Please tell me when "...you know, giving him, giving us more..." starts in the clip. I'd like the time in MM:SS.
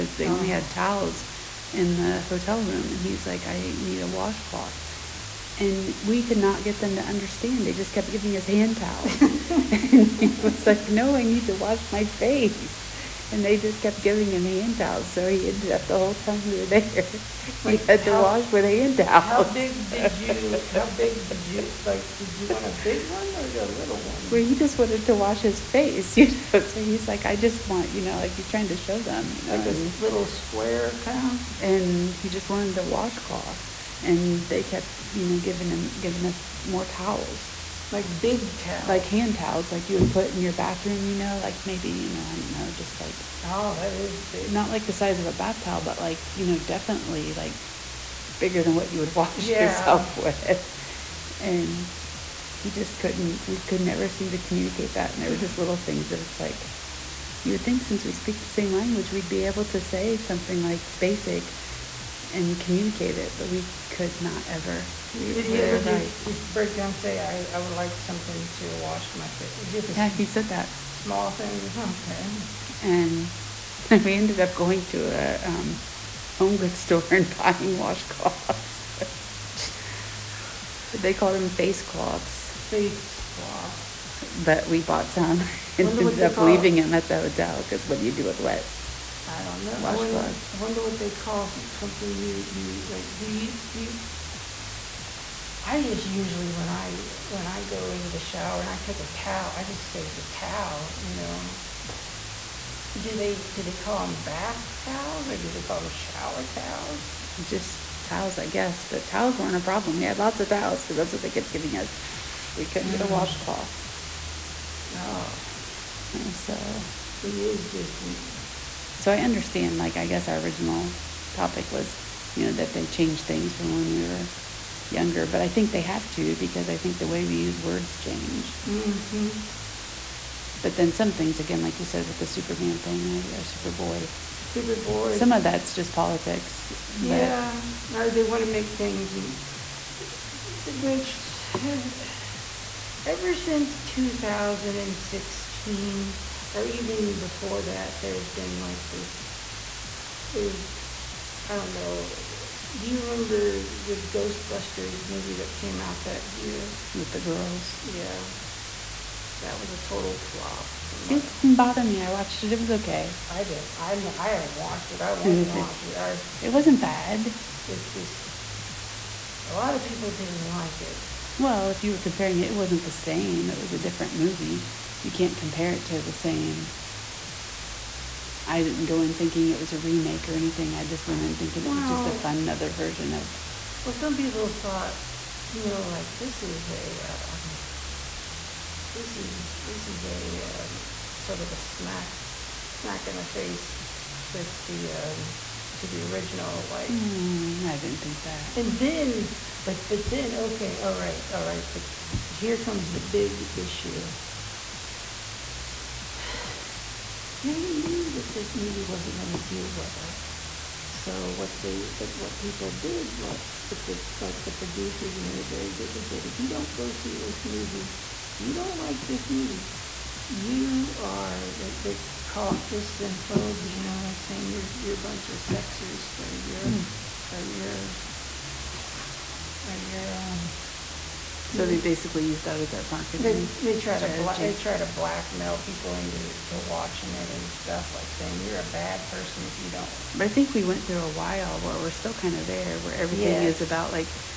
00:35.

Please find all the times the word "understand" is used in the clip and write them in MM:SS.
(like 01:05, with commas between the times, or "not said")
00:07, 01:59.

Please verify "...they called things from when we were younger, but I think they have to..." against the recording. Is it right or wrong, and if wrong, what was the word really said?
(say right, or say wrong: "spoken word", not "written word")
wrong: "changed", not "called".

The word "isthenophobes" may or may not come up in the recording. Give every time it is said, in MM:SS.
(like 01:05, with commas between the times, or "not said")
03:42.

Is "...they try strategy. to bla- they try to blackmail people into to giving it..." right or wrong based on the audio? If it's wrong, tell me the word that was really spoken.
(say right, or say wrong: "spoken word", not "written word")
wrong: "watching", not "giving".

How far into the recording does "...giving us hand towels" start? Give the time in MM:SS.
00:08.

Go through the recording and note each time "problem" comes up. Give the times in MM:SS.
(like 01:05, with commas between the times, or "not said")
01:49.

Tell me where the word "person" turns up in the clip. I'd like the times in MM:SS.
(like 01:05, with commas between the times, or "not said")
03:59.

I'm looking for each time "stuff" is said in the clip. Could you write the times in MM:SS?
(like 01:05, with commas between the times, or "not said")
03:57.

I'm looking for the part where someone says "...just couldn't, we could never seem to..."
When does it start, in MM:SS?
00:52.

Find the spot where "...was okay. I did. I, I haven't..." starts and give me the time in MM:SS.
02:42.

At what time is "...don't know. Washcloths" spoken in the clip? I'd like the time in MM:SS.
01:29.